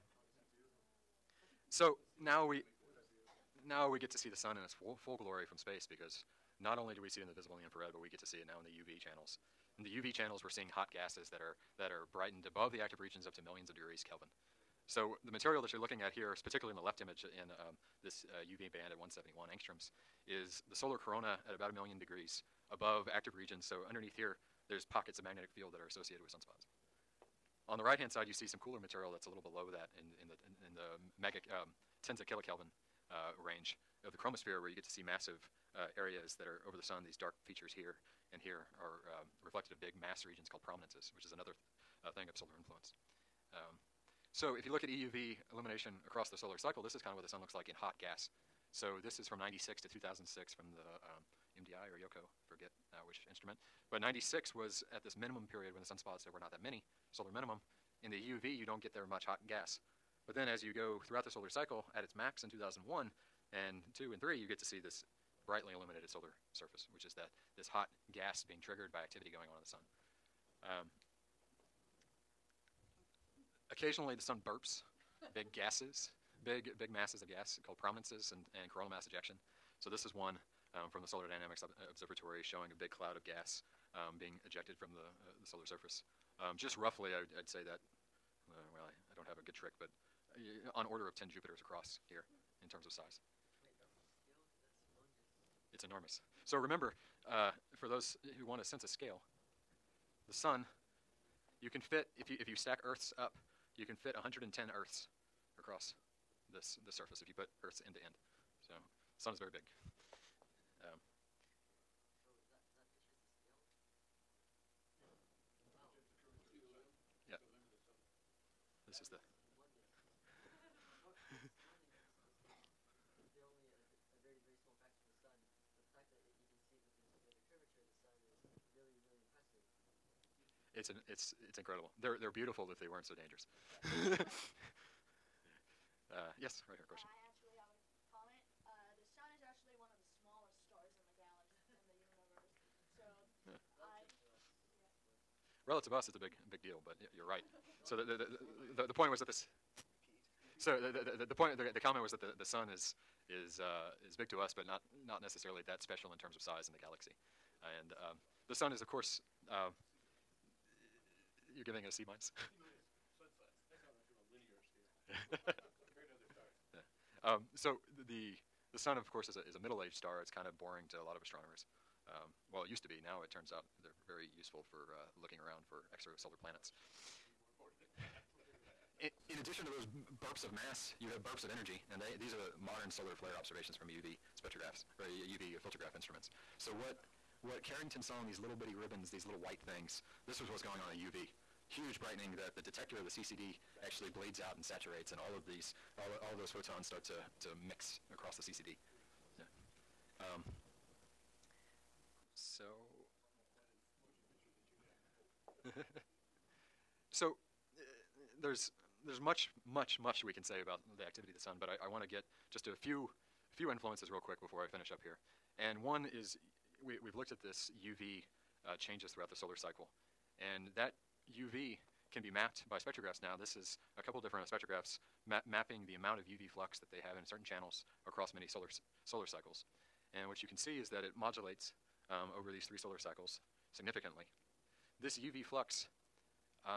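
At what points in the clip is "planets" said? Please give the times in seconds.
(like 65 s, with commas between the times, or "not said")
176 s.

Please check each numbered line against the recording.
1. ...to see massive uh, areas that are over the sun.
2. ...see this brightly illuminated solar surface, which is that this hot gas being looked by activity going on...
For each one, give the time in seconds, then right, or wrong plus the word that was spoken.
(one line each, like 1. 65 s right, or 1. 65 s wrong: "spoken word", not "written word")
1. 34 s right
2. 64 s wrong: "triggered", not "looked".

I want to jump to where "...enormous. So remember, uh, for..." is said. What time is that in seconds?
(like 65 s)
95 s.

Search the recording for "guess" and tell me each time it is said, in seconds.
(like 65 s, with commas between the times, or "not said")
not said.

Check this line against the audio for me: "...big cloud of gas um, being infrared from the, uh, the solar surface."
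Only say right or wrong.
wrong.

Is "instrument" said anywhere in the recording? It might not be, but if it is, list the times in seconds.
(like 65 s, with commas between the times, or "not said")
53 s, 185 s.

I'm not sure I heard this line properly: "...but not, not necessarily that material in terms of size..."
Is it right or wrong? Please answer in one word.
wrong.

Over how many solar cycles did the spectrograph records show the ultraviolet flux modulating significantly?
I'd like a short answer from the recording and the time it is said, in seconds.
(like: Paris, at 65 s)
3, at 232 s.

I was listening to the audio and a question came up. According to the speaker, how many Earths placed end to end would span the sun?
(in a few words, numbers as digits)
110.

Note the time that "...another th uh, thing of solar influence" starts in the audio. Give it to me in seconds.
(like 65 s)
41 s.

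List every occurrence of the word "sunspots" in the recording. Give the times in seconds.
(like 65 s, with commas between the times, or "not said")
26 s, 55 s.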